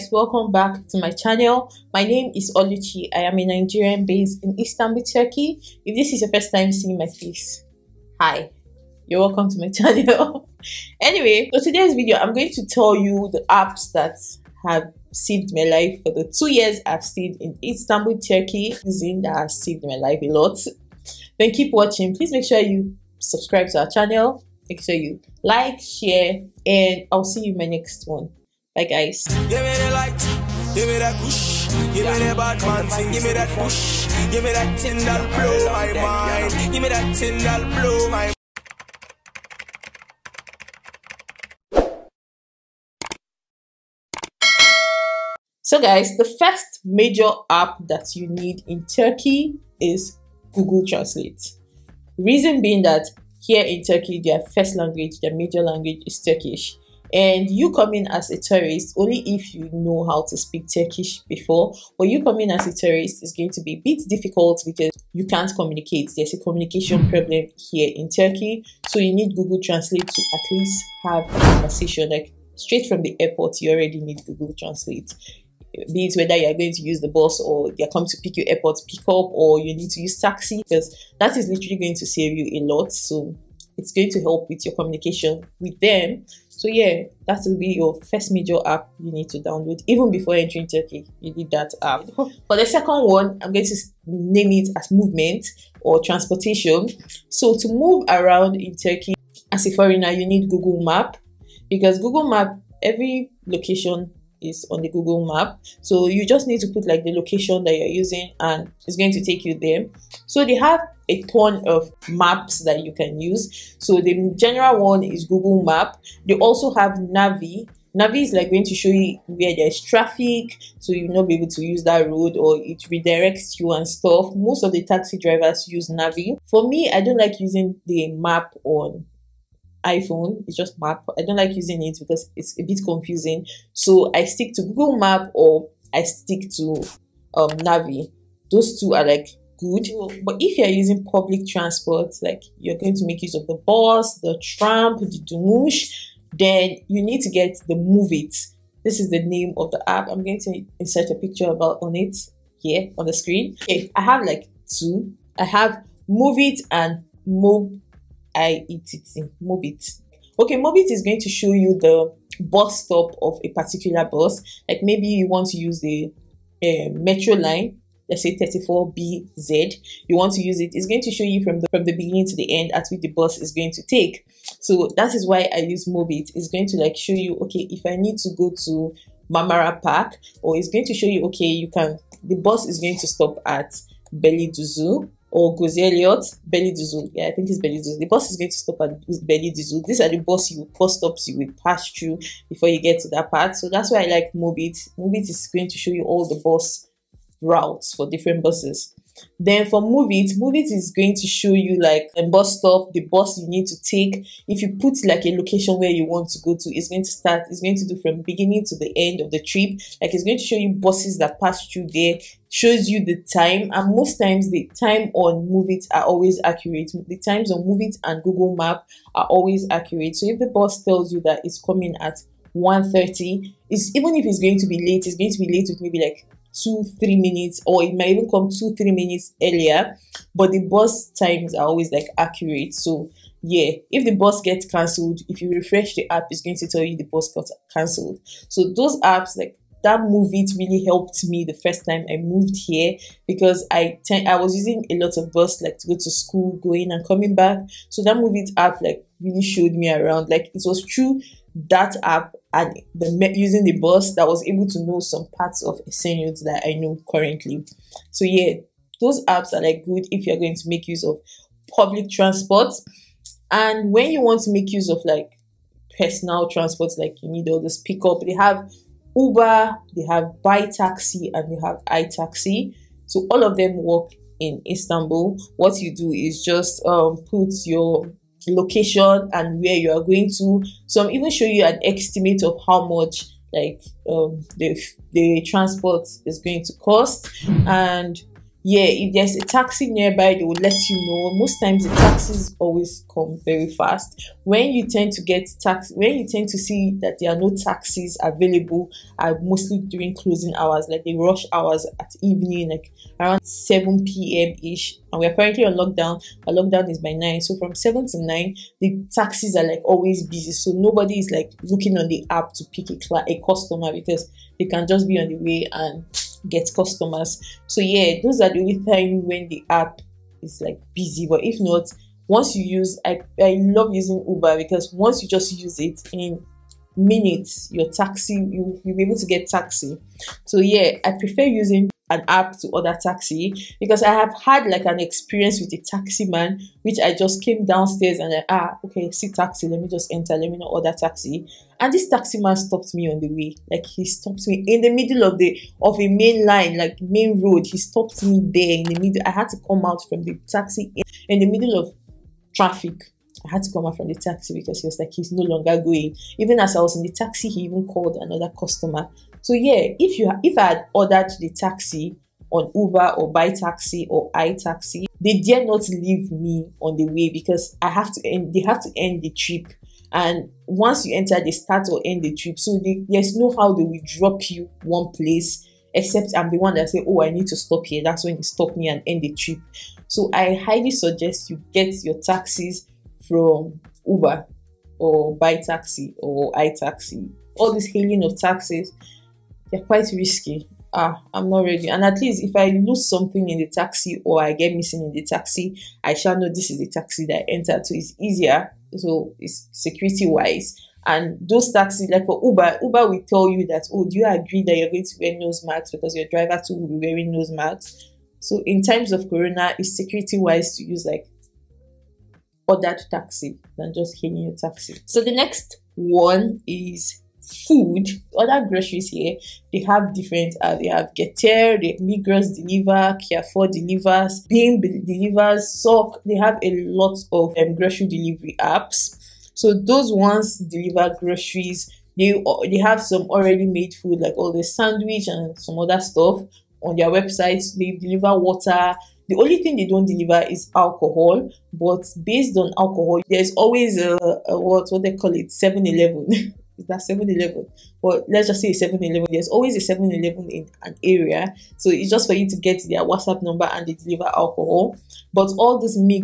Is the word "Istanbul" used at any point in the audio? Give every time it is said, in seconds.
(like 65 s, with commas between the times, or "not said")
4 s, 17 s, 274 s.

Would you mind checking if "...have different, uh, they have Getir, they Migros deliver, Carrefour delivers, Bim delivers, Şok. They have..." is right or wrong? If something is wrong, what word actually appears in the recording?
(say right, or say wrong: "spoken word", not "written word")
right.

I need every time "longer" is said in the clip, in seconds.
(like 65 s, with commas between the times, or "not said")
355 s.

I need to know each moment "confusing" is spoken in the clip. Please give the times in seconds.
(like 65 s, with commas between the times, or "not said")
132 s.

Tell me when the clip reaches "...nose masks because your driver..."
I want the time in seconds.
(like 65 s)
405 s.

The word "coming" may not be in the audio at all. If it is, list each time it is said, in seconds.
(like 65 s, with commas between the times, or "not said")
77 s, 221 s, 247 s.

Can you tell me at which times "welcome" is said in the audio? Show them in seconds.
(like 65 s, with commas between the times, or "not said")
0 s, 9 s.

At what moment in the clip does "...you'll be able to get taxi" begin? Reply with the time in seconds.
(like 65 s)
328 s.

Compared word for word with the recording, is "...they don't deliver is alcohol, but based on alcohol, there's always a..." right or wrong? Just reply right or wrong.
right.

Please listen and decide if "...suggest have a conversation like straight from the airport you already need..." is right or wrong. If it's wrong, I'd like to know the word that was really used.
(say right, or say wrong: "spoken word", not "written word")
wrong: "least", not "suggest".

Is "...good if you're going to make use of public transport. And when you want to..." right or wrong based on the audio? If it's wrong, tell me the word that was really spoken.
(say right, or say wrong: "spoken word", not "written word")
right.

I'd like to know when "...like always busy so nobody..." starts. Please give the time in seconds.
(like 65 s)
309 s.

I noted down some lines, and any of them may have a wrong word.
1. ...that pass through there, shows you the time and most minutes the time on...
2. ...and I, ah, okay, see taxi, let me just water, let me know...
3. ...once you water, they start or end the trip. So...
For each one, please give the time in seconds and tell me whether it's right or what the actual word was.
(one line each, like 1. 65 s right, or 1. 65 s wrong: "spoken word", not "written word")
1. 211 s wrong: "times", not "minutes"
2. 338 s wrong: "enter", not "water"
3. 370 s wrong: "enter", not "water".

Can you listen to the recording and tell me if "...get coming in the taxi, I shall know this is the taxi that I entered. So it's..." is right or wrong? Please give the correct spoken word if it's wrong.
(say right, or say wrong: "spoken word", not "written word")
wrong: "missing", not "coming".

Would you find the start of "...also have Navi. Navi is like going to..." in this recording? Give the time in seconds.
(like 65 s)
116 s.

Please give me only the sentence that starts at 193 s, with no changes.
So that's why I like Mobiett.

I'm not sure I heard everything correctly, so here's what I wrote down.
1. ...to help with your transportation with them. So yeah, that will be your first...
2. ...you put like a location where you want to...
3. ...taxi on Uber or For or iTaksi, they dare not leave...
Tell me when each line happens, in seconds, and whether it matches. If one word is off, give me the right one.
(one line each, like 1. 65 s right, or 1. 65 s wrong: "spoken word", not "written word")
1. 84 s wrong: "communication", not "transportation"
2. 204 s right
3. 361 s wrong: "BiTaksi", not "For".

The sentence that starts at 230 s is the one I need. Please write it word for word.
But the bus times are always like accurate.